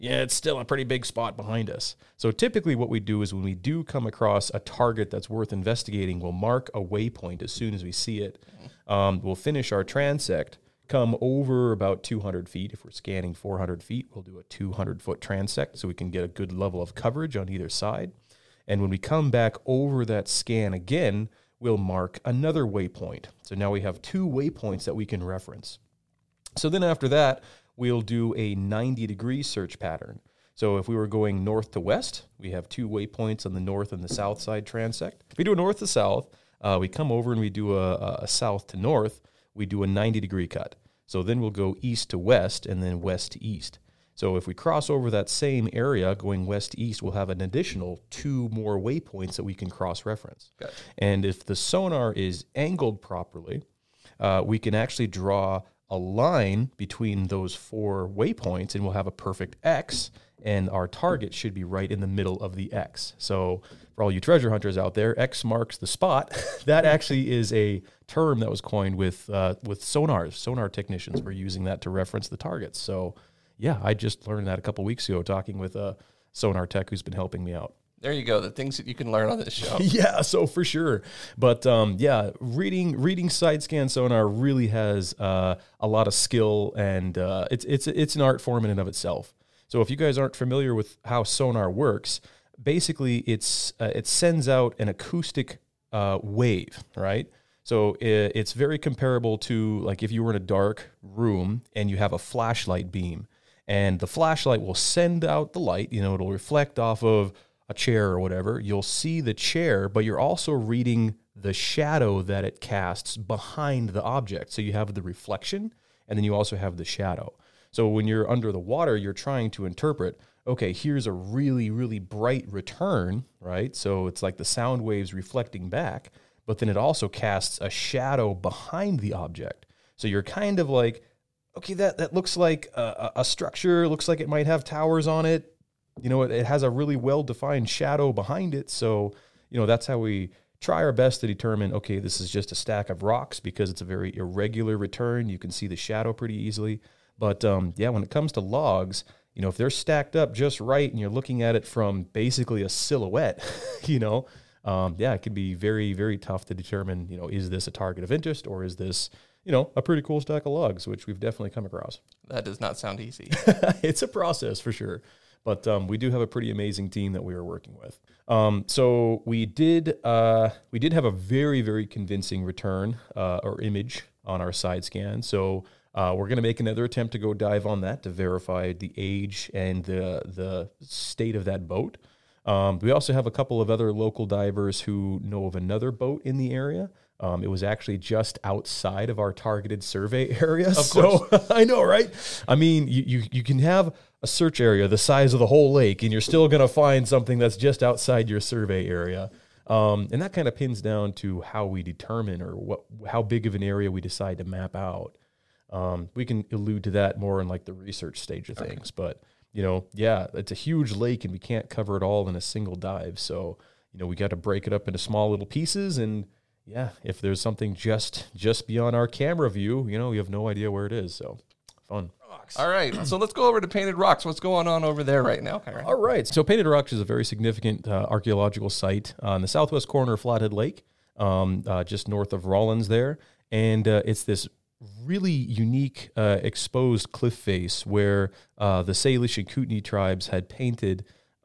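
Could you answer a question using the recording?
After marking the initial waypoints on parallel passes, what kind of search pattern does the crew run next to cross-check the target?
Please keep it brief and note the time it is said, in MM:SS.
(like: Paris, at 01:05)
90 degree search pattern, at 00:28.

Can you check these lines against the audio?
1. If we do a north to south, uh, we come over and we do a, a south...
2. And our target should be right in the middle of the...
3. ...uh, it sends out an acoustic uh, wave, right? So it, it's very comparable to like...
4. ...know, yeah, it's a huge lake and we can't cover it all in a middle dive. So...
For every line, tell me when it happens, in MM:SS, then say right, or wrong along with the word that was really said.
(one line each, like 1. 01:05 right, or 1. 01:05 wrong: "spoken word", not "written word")
1. 00:35 right
2. 01:00 right
3. 01:33 right
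4. 03:29 wrong: "single", not "middle".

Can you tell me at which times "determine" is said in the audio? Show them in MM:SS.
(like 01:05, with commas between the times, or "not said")
02:21, 02:36, 03:21.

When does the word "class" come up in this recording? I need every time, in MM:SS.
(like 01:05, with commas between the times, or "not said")
not said.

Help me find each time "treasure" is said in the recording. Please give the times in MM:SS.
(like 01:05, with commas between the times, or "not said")
01:04.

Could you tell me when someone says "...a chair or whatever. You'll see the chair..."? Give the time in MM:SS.
01:47.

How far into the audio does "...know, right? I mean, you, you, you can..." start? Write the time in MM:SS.
03:11.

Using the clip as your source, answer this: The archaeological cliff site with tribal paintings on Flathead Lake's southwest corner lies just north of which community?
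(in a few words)
Rollins.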